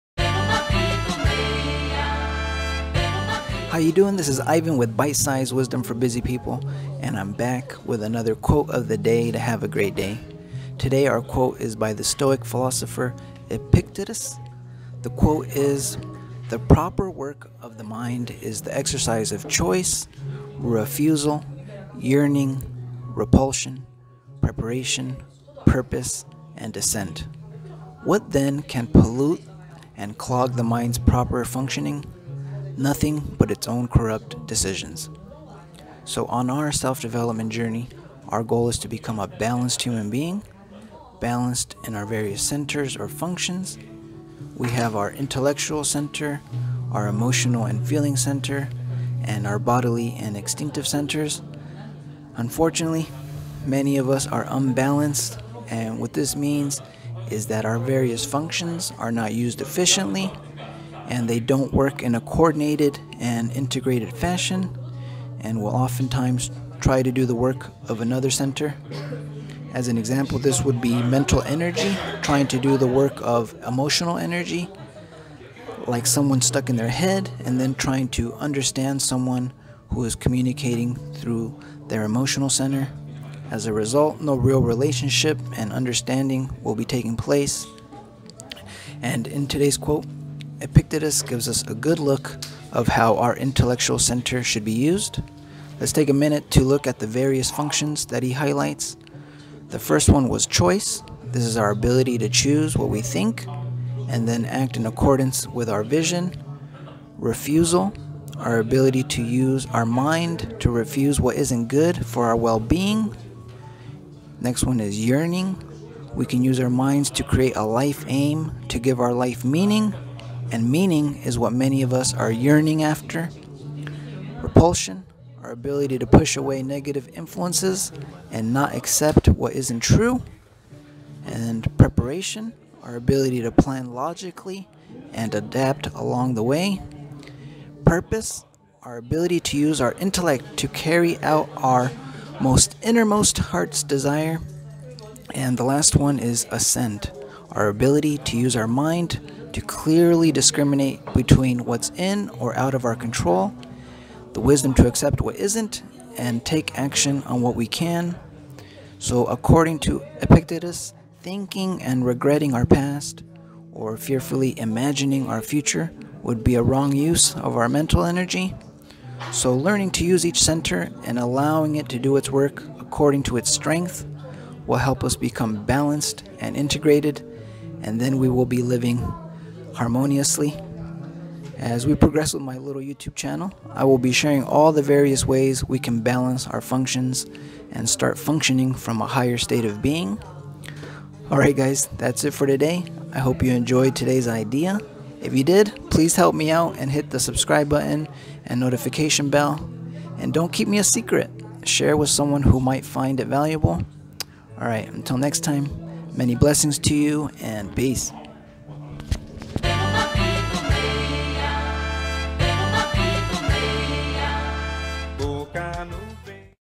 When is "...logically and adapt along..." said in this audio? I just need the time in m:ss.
2:13.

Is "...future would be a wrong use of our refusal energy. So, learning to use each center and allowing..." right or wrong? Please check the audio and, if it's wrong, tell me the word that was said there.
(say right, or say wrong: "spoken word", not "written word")
wrong: "mental", not "refusal".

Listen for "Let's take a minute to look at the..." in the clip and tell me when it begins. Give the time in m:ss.
1:35.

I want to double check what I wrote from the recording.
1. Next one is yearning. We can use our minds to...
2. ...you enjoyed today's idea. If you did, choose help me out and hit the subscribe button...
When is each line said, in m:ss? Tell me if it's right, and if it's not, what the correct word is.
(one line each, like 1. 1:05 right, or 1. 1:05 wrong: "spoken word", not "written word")
1. 1:54 right
2. 3:13 wrong: "please", not "choose".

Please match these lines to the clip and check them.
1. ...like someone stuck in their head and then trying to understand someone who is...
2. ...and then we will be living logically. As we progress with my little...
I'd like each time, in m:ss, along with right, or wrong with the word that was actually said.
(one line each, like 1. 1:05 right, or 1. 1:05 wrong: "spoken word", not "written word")
1. 1:15 right
2. 2:57 wrong: "harmoniously", not "logically".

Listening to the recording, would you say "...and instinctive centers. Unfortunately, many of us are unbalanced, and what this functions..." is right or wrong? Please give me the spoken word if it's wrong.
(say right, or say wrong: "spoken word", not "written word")
wrong: "means", not "functions".